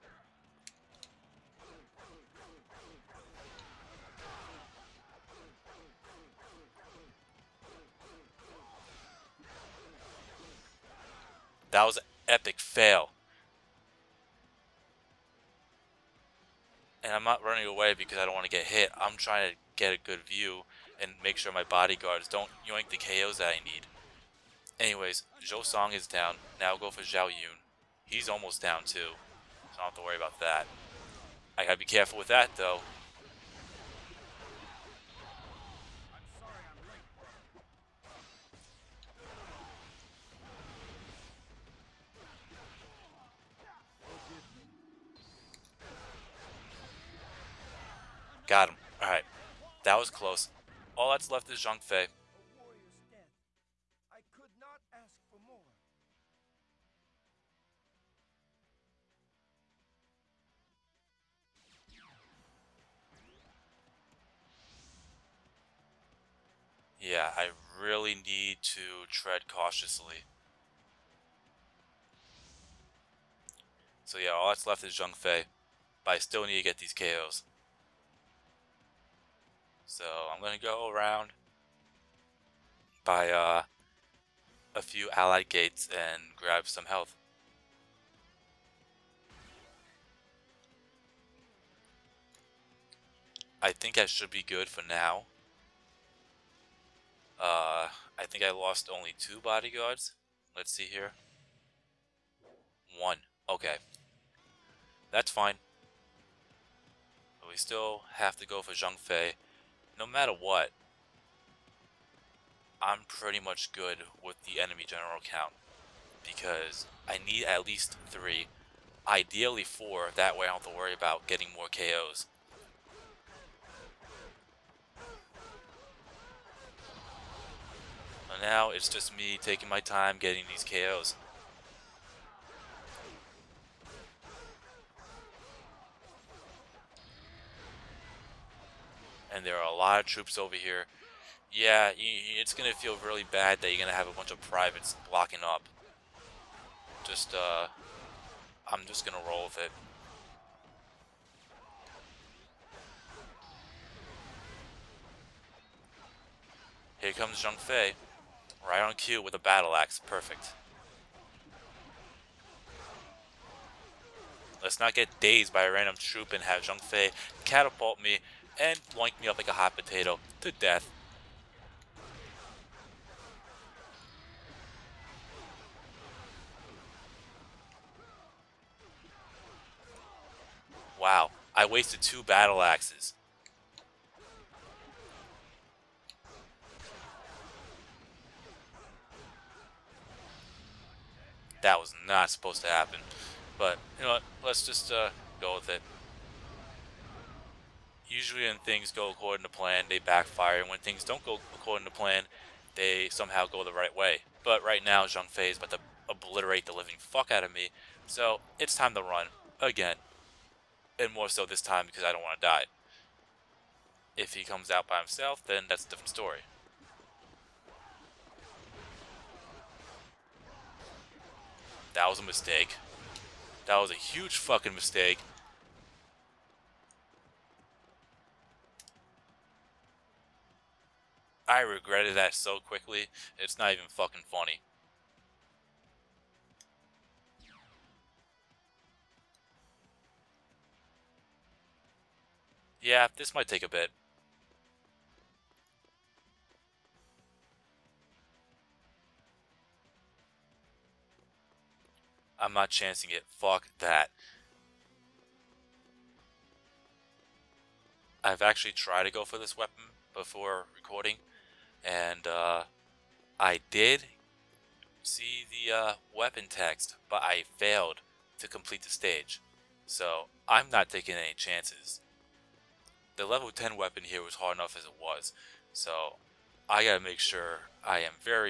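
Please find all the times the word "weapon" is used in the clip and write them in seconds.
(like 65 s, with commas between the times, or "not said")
259 s, 266 s, 273 s.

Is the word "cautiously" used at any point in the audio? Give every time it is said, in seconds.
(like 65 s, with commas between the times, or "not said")
69 s.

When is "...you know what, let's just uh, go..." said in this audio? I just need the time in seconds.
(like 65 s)
193 s.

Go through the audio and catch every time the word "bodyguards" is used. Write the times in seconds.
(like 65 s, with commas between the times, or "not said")
21 s, 99 s.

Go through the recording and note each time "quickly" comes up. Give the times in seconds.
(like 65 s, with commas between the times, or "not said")
232 s.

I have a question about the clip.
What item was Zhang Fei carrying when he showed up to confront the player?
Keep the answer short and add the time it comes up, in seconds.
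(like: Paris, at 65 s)
battle axe, at 159 s.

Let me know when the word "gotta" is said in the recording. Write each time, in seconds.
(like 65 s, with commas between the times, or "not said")
31 s, 276 s.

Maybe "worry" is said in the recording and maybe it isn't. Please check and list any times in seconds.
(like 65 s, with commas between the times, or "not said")
30 s, 120 s.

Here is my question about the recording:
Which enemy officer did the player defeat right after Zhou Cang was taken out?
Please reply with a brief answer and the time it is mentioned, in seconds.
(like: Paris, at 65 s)
Zhao Yun, at 27 s.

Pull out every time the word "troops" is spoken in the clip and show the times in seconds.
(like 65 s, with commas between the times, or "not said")
140 s, 165 s.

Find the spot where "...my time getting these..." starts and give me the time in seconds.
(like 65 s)
129 s.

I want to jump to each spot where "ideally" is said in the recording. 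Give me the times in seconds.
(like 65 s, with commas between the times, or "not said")
119 s.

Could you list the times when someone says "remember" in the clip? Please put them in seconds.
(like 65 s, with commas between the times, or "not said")
not said.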